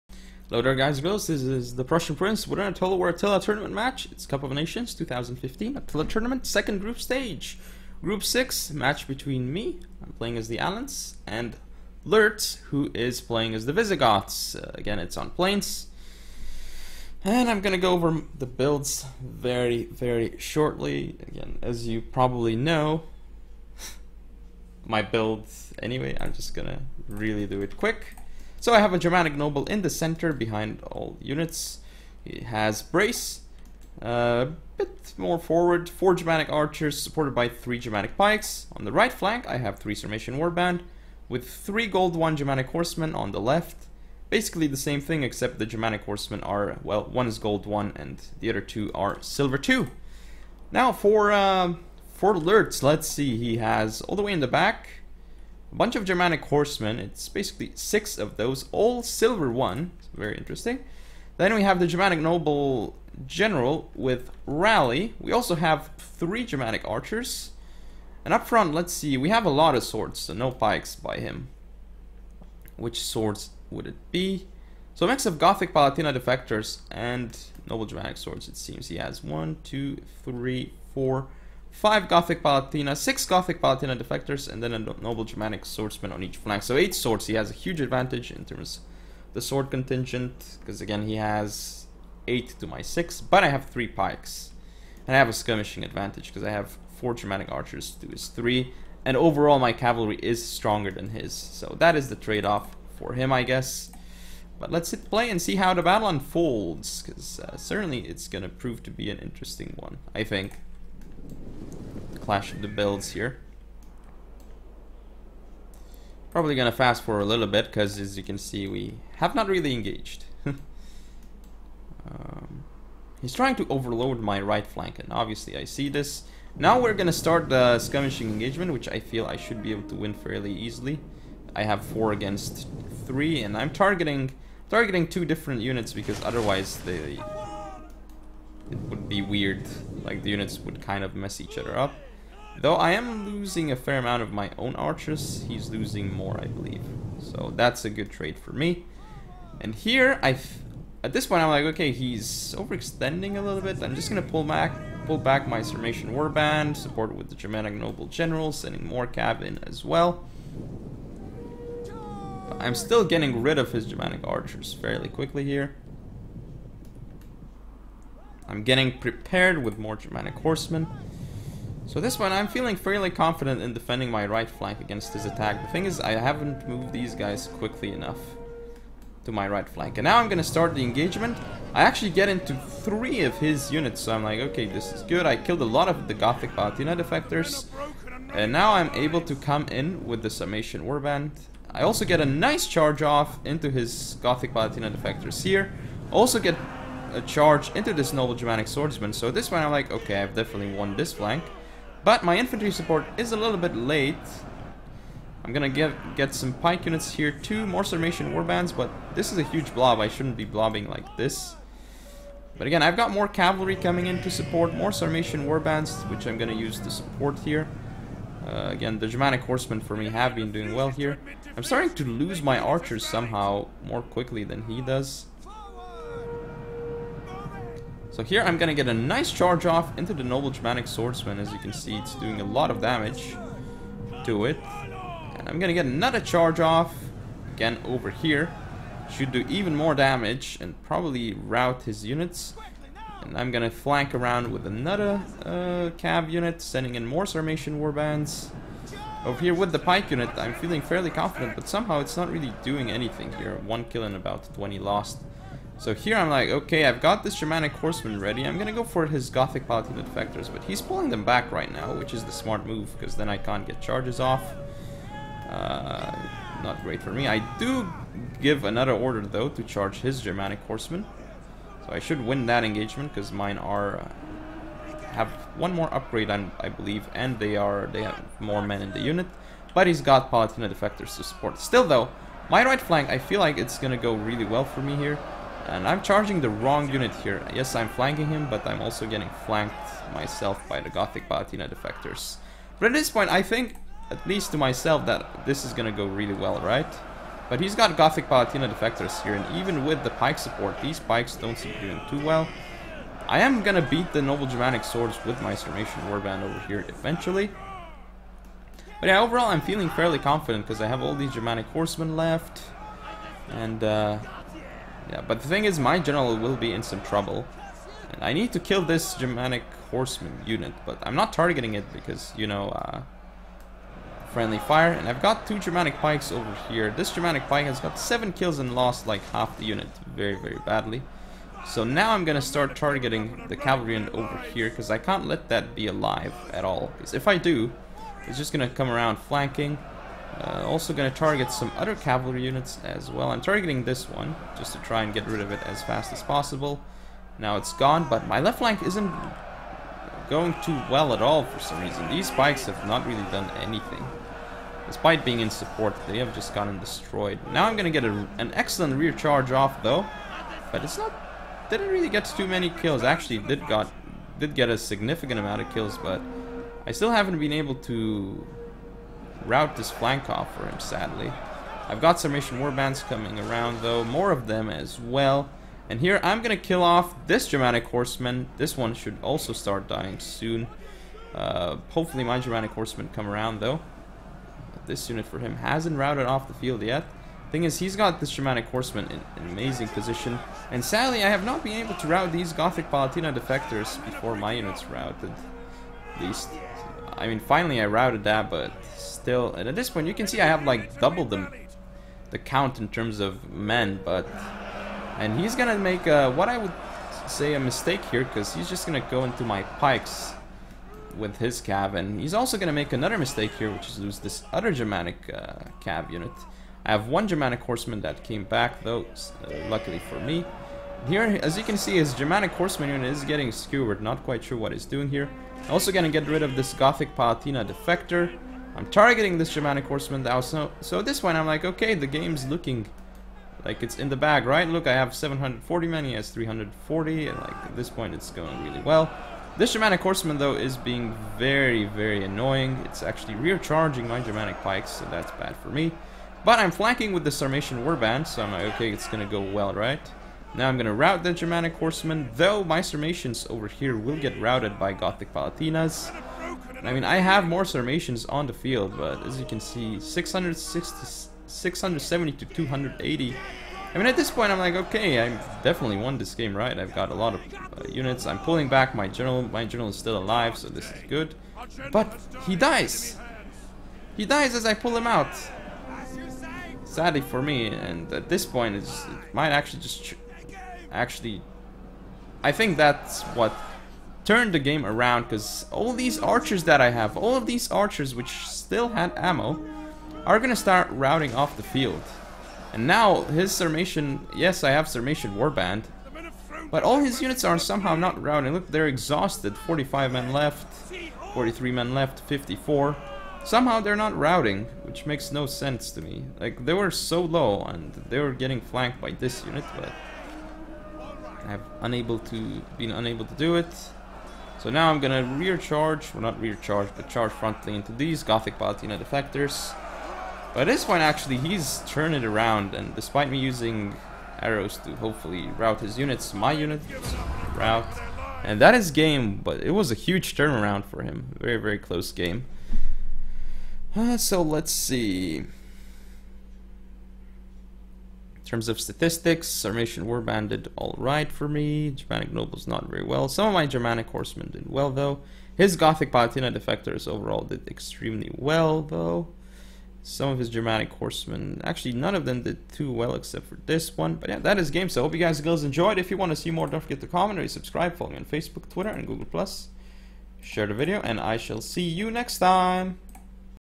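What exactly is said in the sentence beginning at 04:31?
So I should win that engagement, because mine are...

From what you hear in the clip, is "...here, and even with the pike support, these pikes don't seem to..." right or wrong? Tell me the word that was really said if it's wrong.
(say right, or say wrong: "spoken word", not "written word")
right.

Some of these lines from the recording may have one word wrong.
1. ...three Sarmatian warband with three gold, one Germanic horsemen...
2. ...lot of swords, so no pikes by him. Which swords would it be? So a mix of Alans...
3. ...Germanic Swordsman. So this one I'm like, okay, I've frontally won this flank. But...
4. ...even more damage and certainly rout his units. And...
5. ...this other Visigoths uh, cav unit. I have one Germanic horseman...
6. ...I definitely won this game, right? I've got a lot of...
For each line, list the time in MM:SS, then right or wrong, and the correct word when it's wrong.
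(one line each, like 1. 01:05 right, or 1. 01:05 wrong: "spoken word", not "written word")
1. 00:39 right
2. 01:09 wrong: "Gothic", not "Alans"
3. 03:18 wrong: "definitely", not "frontally"
4. 03:59 wrong: "probably", not "certainly"
5. 06:54 wrong: "Germanic", not "Visigoths"
6. 07:45 right.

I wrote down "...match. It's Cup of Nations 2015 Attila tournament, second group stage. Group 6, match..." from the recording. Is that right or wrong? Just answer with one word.
right.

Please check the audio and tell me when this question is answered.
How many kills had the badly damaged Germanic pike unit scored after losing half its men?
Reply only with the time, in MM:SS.
05:27.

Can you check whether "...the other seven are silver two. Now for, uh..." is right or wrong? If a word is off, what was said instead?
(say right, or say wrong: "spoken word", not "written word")
wrong: "two", not "seven".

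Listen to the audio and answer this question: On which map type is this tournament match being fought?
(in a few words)
plains.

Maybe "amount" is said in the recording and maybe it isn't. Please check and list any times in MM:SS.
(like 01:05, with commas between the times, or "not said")
02:23, 06:05.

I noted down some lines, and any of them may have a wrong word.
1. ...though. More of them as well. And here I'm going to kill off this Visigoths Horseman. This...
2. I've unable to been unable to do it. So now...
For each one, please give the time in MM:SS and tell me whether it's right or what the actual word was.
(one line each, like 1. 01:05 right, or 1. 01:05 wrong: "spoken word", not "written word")
1. 06:13 wrong: "Germanic", not "Visigoths"
2. 08:31 right.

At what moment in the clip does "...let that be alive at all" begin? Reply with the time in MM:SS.
05:35.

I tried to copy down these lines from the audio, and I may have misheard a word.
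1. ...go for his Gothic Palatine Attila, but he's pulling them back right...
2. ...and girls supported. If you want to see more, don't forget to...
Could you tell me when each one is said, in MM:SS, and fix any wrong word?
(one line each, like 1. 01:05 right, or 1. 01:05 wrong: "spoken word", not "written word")
1. 04:18 wrong: "Defectors", not "Attila"
2. 09:15 wrong: "enjoyed", not "supported".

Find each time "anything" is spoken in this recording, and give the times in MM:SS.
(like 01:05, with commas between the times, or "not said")
04:12, 05:53.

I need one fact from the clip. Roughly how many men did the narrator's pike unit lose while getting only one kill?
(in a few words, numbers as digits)
about 20.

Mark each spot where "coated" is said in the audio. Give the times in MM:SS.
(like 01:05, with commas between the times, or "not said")
not said.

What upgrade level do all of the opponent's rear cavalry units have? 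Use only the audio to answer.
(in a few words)
silver one.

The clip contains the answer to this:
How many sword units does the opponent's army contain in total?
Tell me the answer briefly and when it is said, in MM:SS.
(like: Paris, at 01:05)
8, at 01:26.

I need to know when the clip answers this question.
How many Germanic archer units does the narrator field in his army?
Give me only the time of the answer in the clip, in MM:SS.
00:35.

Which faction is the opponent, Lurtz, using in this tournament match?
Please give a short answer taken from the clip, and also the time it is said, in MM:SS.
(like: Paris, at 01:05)
Visigoths, at 00:13.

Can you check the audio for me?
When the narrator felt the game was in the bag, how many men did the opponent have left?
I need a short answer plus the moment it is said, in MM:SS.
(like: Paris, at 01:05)
340, at 07:16.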